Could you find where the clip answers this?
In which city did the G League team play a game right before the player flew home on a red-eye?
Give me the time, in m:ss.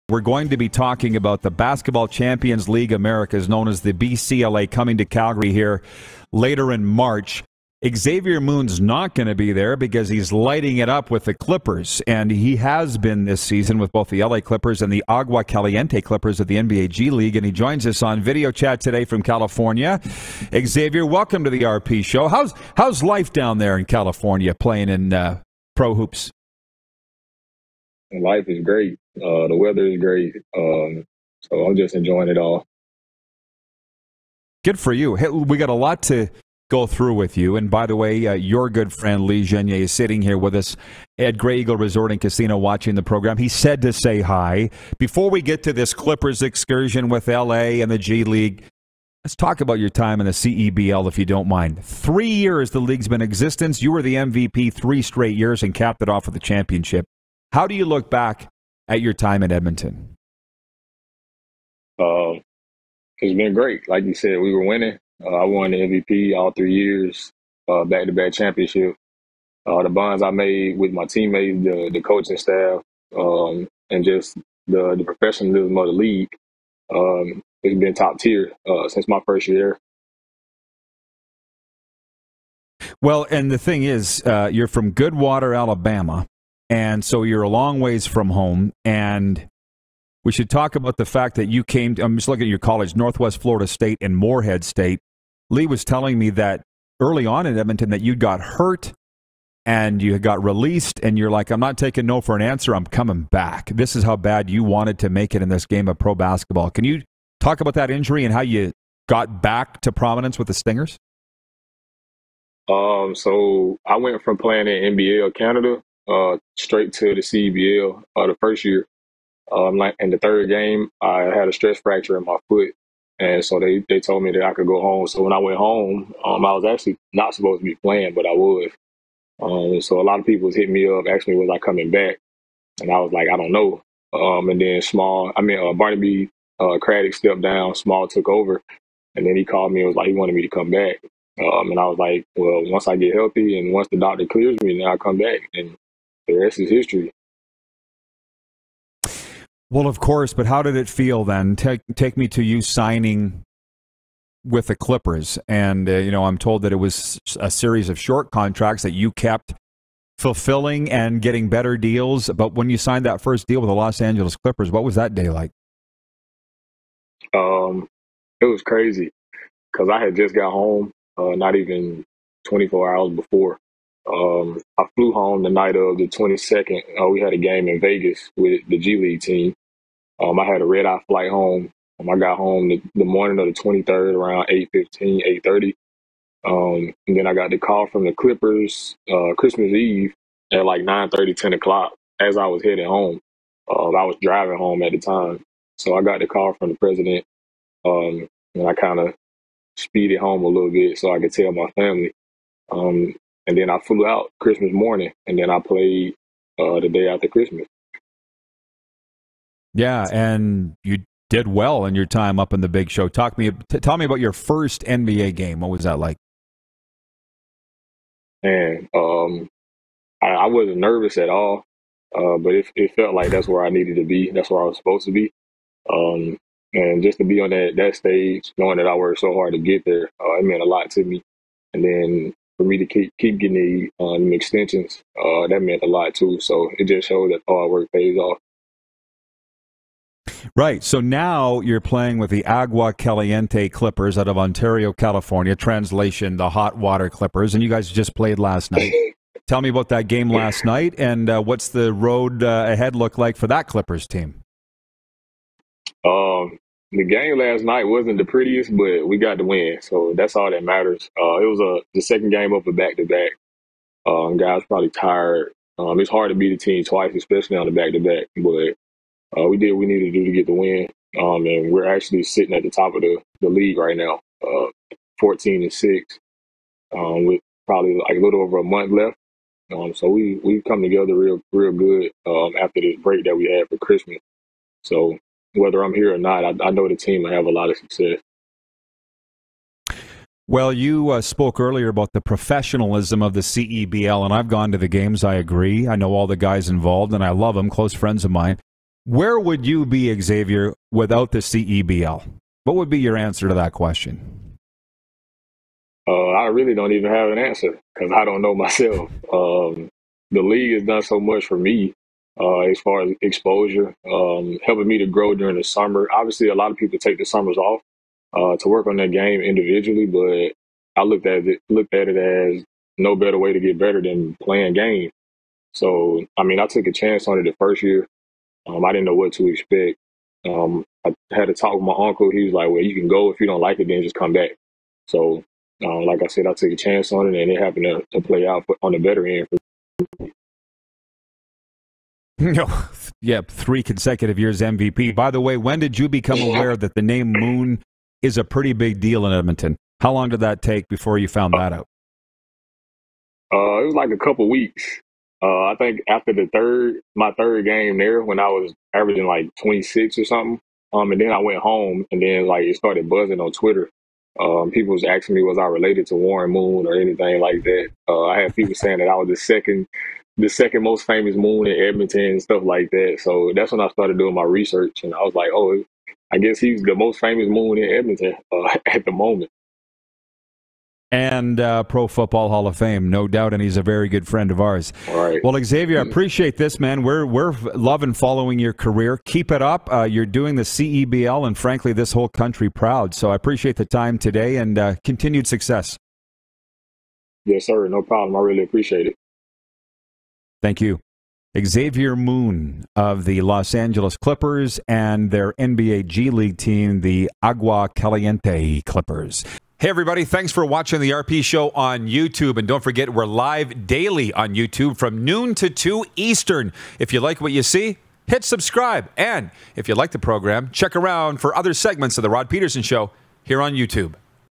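2:57.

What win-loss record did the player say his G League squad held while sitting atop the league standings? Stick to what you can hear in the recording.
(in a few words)
14-6.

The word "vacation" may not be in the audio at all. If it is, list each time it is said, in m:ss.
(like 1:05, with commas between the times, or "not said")
not said.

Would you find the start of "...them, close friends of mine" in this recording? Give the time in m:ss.
4:57.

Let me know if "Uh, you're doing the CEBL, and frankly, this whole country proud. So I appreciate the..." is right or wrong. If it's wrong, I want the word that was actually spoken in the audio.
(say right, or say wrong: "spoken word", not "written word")
right.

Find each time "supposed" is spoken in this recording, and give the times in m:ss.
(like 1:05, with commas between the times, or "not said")
2:07, 3:44.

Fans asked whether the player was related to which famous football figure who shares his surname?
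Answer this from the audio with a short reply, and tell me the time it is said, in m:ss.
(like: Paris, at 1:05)
Warren Moon, at 6:06.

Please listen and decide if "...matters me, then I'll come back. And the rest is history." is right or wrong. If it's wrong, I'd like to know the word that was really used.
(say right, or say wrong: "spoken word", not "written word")
wrong: "clears", not "matters".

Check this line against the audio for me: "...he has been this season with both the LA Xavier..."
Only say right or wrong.
wrong.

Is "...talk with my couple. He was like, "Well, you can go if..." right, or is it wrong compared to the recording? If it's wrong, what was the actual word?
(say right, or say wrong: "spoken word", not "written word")
wrong: "uncle", not "couple".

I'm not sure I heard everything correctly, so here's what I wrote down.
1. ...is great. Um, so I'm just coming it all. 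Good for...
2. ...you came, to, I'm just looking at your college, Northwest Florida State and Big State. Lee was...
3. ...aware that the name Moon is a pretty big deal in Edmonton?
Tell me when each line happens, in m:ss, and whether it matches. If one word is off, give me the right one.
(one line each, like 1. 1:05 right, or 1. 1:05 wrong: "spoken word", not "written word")
1. 0:29 wrong: "enjoying", not "coming"
2. 1:31 wrong: "Morehead", not "Big"
3. 5:46 right.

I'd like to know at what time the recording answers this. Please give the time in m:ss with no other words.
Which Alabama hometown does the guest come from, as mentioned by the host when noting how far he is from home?
1:24.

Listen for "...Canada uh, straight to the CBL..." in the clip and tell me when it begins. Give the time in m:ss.
1:55.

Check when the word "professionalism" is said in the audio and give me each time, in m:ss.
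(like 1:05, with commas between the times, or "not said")
1:15, 4:52.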